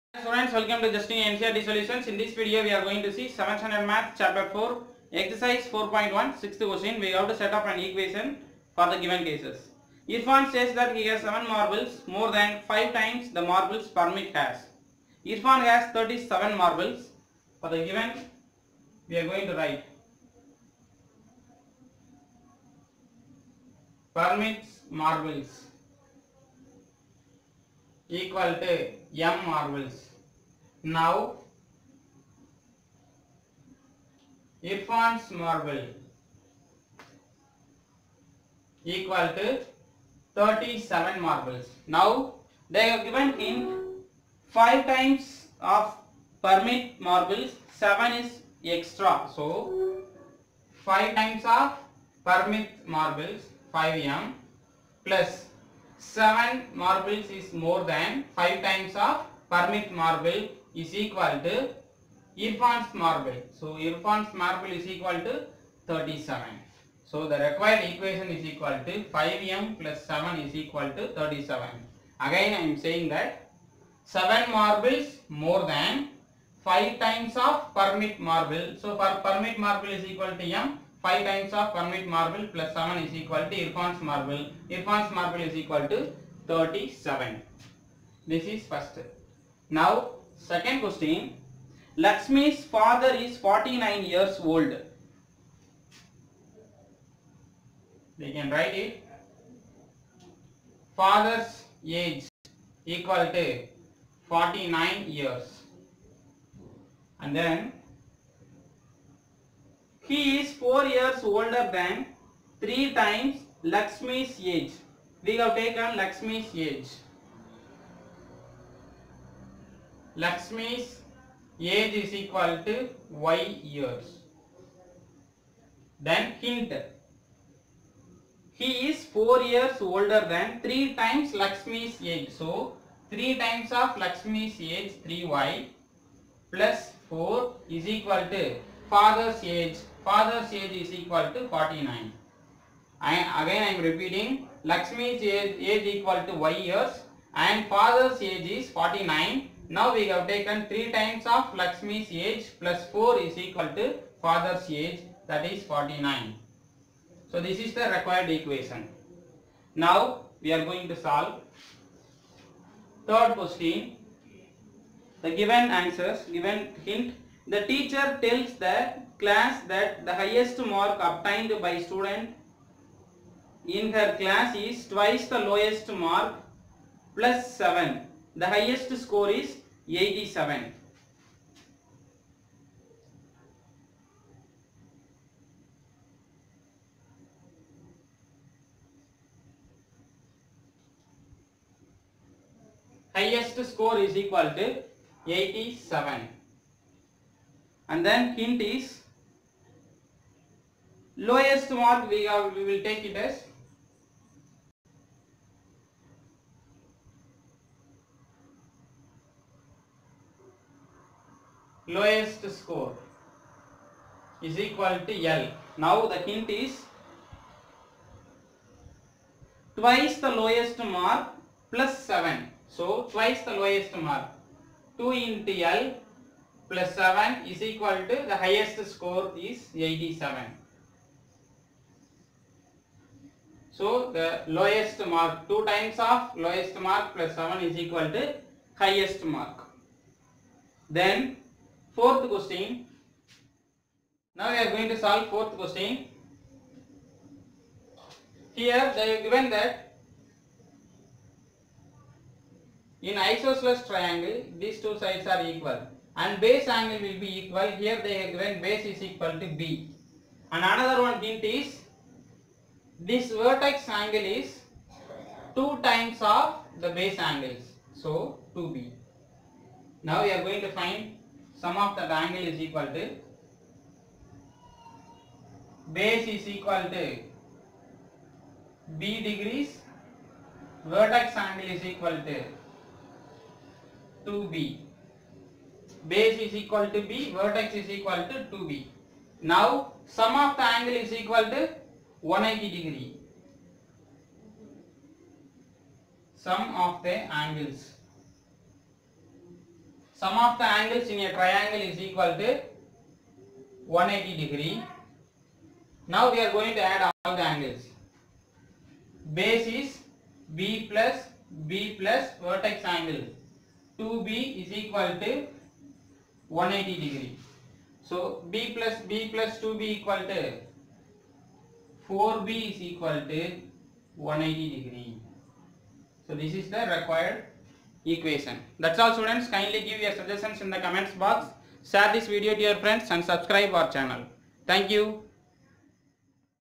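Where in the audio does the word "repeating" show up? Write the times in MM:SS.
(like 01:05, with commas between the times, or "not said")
02:23.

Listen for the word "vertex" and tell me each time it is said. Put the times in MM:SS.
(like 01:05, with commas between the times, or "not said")
04:23, 04:40, 04:47, 05:12.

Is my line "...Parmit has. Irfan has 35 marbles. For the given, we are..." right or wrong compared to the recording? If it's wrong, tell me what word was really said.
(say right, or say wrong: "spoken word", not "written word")
wrong: "37", not "35".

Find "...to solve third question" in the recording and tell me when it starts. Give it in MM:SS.
02:40.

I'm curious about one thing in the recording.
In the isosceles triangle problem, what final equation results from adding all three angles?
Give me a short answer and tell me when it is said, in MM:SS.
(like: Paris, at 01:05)
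4B = 180°, at 05:22.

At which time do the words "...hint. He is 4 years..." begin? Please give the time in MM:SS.
02:06.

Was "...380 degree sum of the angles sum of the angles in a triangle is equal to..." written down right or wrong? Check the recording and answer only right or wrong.
wrong.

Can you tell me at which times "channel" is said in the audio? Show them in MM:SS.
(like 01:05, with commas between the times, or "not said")
05:33.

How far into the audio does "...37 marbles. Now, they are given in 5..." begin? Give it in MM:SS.
00:40.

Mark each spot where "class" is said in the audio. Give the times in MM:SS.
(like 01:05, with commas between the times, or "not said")
02:49, 02:54.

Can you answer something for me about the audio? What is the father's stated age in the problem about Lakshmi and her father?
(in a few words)
49.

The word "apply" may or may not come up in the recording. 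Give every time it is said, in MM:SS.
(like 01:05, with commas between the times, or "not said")
not said.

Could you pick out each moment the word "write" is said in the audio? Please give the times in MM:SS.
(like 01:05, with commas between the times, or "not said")
00:19, 01:38.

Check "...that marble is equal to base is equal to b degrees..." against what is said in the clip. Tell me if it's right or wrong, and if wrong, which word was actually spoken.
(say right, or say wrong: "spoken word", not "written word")
wrong: "angle", not "marble".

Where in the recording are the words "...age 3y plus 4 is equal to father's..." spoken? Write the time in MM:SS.
02:14.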